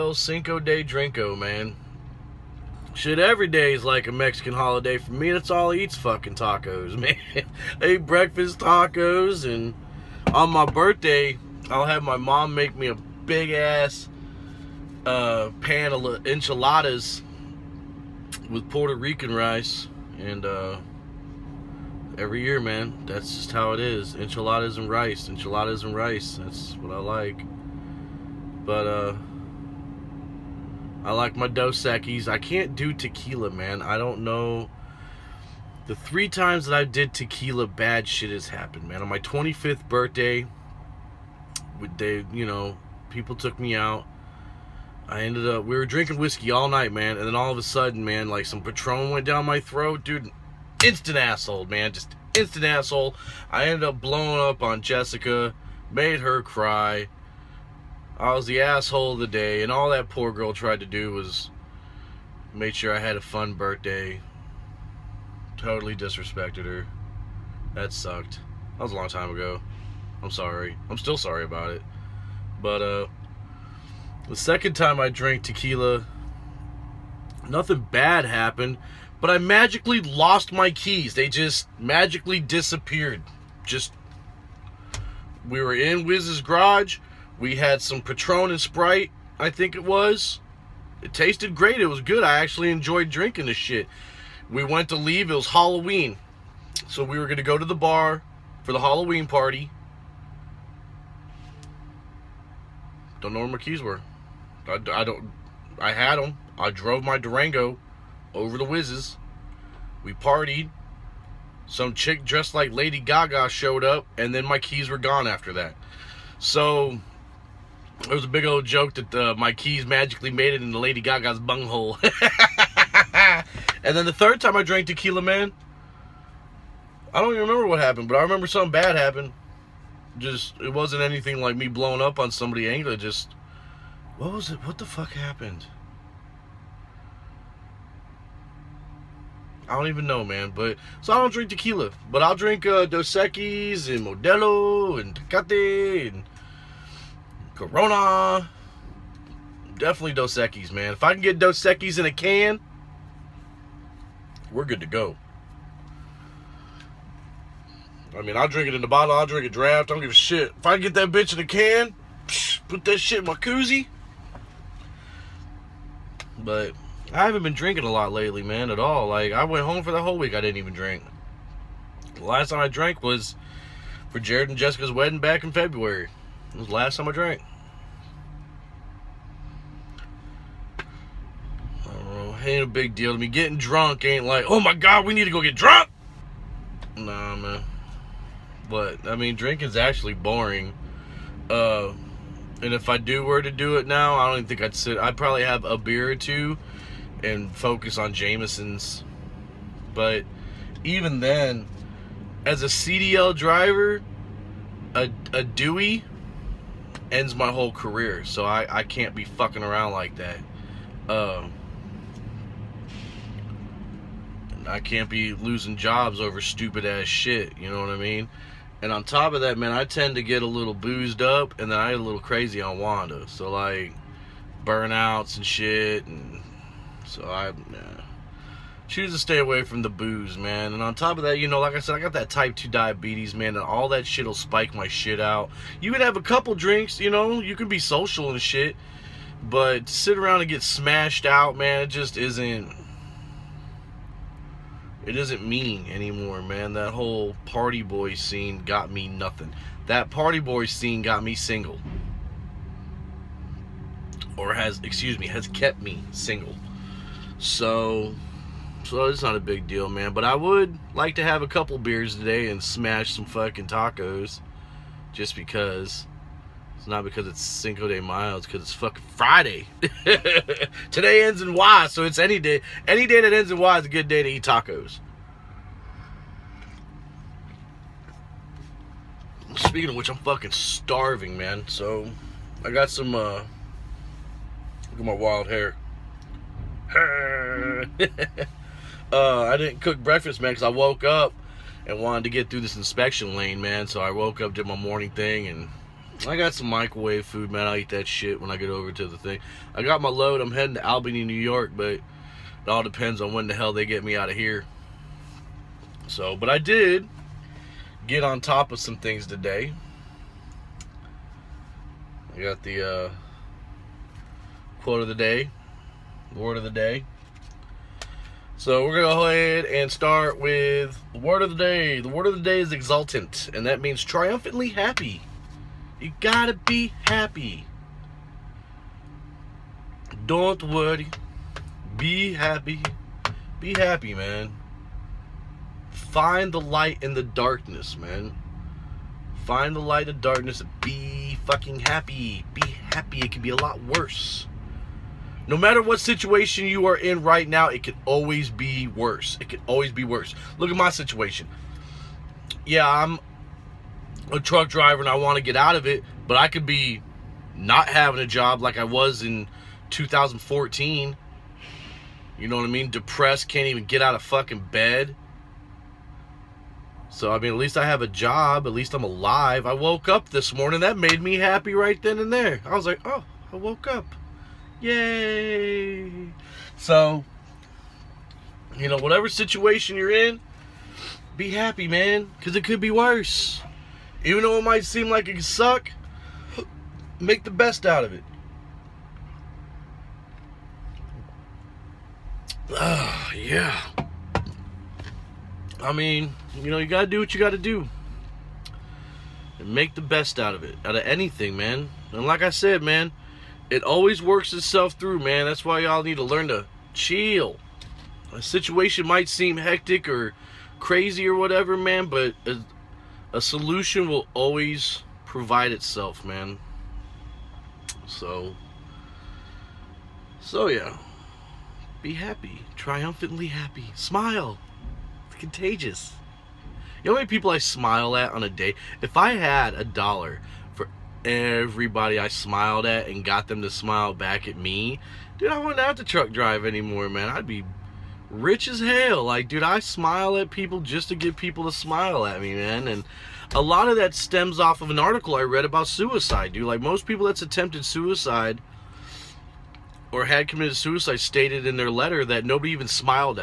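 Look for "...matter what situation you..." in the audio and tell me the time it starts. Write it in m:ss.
5:45.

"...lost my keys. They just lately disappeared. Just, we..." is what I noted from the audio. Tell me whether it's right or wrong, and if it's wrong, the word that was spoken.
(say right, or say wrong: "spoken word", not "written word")
wrong: "magically", not "lately".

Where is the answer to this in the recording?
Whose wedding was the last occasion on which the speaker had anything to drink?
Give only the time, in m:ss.
2:54.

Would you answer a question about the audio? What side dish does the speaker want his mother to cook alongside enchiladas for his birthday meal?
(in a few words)
Puerto Rican rice.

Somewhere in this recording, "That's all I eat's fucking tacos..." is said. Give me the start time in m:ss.
0:05.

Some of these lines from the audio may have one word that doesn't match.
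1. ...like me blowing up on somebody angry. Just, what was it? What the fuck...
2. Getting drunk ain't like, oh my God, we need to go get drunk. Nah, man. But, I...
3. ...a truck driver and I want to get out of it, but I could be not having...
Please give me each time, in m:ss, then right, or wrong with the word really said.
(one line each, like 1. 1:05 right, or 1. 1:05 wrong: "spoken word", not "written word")
1. 2:11 right
2. 3:03 right
3. 5:54 right.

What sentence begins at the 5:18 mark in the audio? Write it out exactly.
So we're going to go ahead and start with the word of the day.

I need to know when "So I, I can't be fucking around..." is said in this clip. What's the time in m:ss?
3:28.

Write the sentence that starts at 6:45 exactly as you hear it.
That's why y'all need to learn to chill.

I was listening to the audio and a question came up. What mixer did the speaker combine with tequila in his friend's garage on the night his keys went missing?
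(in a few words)
Sprite.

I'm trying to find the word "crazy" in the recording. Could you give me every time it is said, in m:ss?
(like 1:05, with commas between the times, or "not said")
3:42, 6:50.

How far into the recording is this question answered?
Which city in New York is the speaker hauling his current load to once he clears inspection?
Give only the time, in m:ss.
5:00.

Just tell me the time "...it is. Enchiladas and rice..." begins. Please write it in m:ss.
0:23.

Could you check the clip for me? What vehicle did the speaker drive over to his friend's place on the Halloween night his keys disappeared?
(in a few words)
Durango.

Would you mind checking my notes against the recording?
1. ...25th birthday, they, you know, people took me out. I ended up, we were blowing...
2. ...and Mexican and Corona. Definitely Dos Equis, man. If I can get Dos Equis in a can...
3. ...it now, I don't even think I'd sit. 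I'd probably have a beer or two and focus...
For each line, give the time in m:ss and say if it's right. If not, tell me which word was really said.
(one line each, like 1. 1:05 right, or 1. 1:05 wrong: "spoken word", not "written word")
1. 0:39 wrong: "drinking", not "blowing"
2. 2:24 wrong: "Tecate", not "Mexican"
3. 3:13 right.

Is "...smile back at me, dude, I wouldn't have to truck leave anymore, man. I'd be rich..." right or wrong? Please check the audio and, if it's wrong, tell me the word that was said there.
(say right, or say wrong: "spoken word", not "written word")
wrong: "drive", not "leave".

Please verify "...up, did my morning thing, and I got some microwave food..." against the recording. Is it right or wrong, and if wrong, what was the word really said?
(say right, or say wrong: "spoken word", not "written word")
right.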